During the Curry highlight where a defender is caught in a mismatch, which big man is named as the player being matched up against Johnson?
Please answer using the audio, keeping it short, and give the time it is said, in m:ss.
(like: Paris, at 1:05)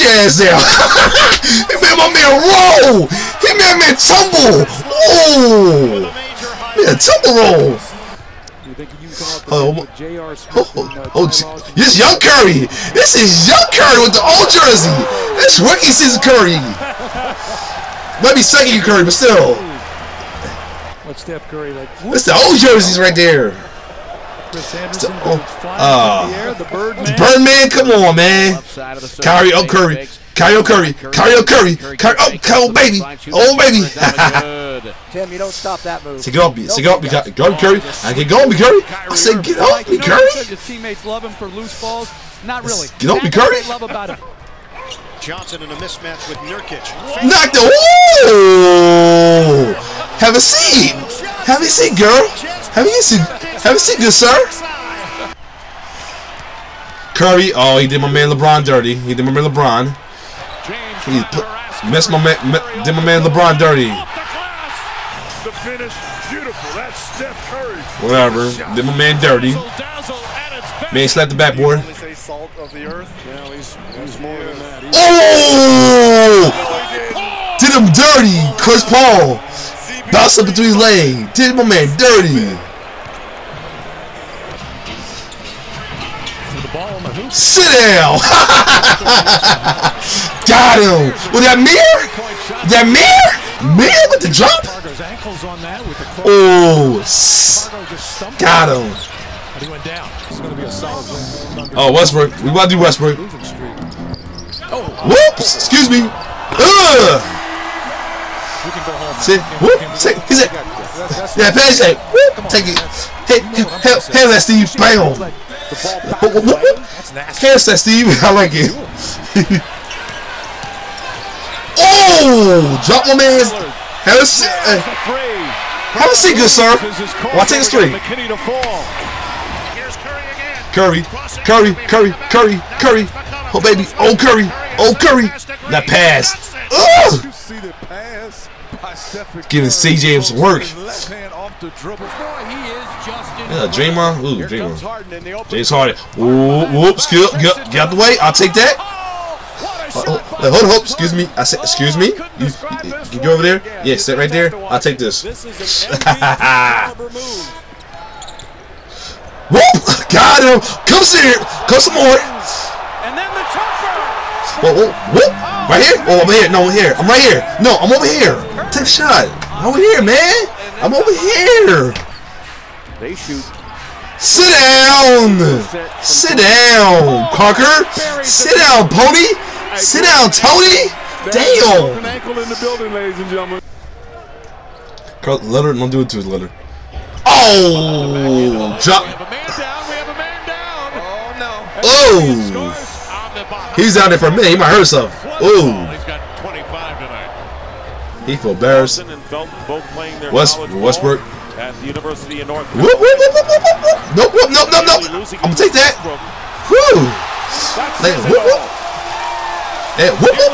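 Nurkic, at 0:46.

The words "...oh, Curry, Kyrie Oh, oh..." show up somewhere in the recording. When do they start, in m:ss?
0:31.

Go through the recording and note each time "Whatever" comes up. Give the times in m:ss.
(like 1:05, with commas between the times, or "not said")
1:08.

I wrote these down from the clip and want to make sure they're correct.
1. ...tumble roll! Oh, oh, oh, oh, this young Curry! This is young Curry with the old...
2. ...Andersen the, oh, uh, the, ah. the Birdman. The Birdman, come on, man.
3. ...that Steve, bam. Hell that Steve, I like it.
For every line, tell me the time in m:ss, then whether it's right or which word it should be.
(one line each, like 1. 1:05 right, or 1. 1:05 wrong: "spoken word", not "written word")
1. 0:06 right
2. 0:24 right
3. 1:54 right.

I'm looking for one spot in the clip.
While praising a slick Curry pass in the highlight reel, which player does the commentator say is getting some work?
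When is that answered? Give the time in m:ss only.
2:19.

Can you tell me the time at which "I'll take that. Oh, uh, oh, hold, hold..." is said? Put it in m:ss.
2:28.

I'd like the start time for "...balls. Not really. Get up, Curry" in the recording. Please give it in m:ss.
0:41.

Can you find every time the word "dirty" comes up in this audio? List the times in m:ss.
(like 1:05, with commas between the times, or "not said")
0:58, 1:03, 1:09, 1:17, 1:21.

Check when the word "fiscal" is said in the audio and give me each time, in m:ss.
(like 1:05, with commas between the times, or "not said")
not said.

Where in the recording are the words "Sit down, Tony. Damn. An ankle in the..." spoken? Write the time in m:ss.
2:59.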